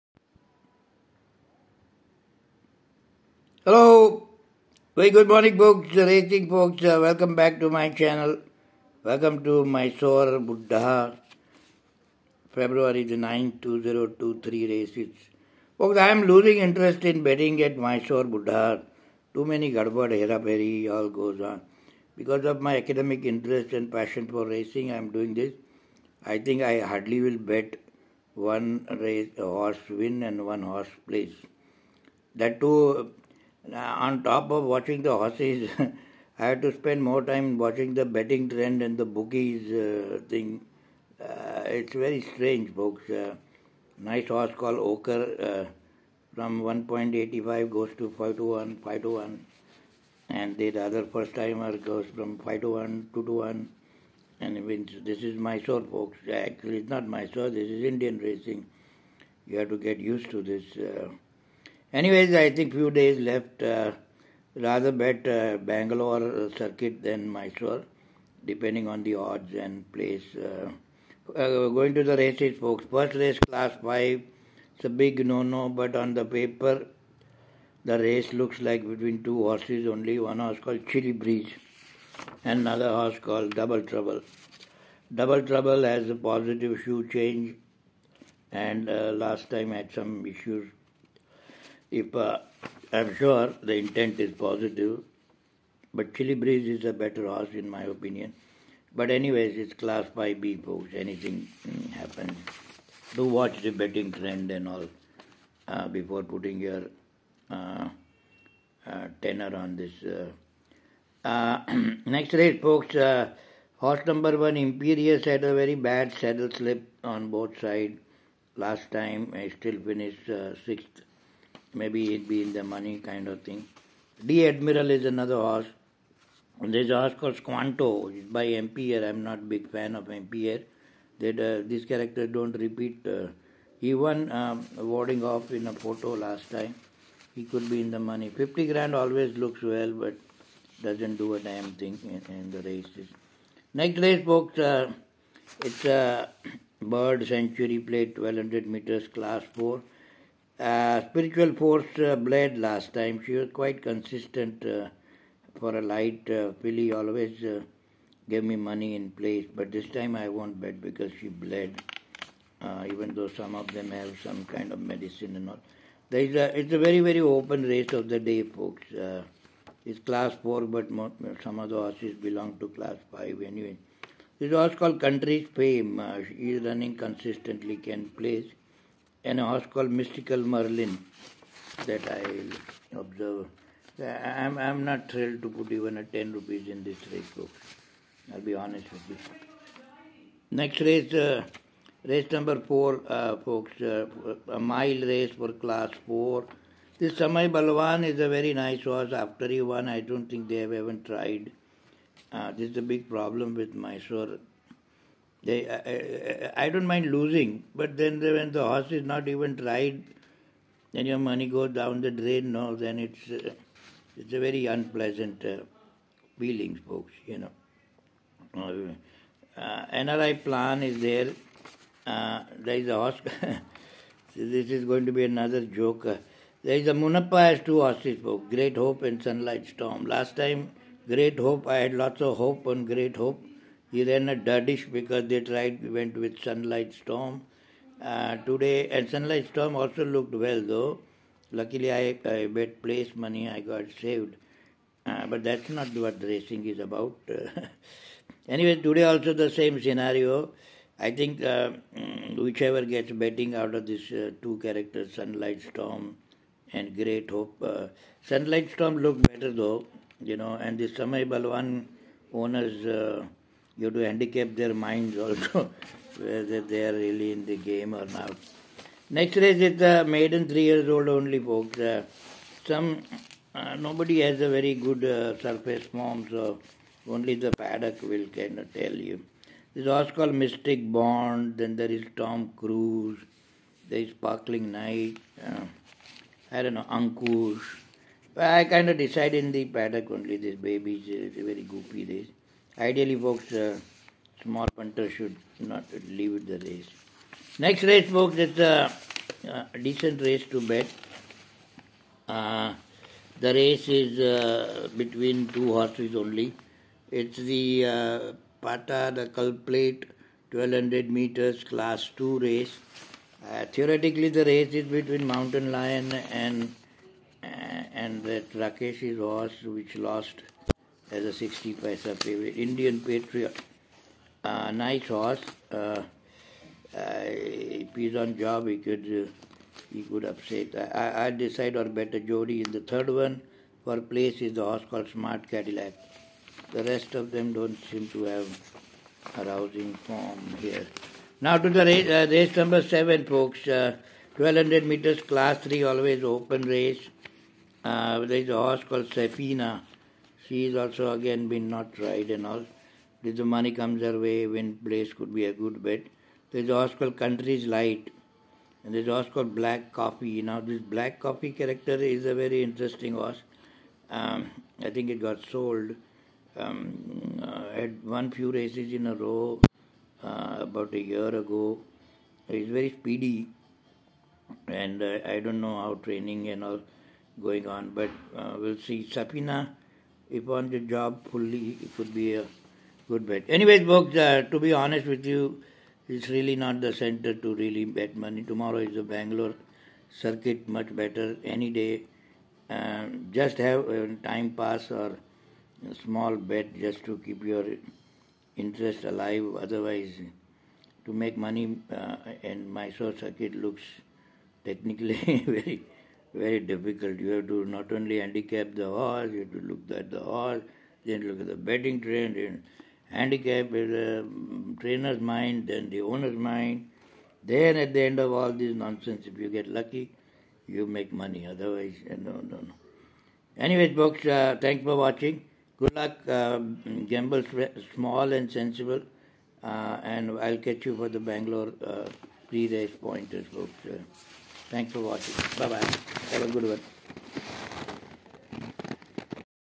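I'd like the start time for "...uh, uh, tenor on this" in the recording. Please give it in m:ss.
1:47.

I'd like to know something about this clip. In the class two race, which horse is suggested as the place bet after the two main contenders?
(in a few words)
Smart Cadillac.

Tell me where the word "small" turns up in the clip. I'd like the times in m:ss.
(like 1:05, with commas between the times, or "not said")
4:54, 6:35, 7:07.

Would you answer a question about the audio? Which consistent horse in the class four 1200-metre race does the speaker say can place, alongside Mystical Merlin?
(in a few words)
Country's Fame.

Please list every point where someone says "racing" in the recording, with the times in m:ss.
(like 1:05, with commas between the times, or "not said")
0:05, 0:24, 0:58, 4:06.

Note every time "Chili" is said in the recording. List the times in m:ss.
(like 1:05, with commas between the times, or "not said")
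1:20, 1:36.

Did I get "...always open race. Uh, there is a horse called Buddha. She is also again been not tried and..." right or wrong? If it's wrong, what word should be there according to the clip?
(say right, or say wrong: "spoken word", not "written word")
wrong: "Safina", not "Buddha".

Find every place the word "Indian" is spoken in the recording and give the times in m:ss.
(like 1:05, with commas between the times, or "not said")
0:57, 5:22.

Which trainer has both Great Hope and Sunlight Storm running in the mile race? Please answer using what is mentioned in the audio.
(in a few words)
Munappa.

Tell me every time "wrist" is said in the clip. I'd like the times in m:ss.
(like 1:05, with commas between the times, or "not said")
not said.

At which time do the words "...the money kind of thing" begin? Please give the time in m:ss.
2:02.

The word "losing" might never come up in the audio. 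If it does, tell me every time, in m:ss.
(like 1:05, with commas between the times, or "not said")
0:16, 3:27.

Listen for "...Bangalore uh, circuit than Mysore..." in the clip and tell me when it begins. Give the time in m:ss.
1:05.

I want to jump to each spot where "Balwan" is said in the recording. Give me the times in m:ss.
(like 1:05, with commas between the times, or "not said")
3:17, 4:21.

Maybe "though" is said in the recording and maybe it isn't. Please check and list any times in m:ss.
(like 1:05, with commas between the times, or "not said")
2:43, 4:00, 4:19.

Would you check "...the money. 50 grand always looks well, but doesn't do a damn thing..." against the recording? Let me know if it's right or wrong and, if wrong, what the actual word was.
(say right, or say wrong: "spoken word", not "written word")
right.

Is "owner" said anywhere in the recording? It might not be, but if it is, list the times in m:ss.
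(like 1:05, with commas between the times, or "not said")
4:22, 6:56.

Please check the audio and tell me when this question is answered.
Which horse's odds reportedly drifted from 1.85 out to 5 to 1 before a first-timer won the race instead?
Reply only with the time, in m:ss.
0:44.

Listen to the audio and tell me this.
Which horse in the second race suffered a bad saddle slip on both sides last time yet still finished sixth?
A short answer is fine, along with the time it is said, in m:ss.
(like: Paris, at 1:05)
Imperious, at 1:54.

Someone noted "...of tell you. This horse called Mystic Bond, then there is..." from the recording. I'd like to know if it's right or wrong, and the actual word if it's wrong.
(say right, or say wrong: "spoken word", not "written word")
right.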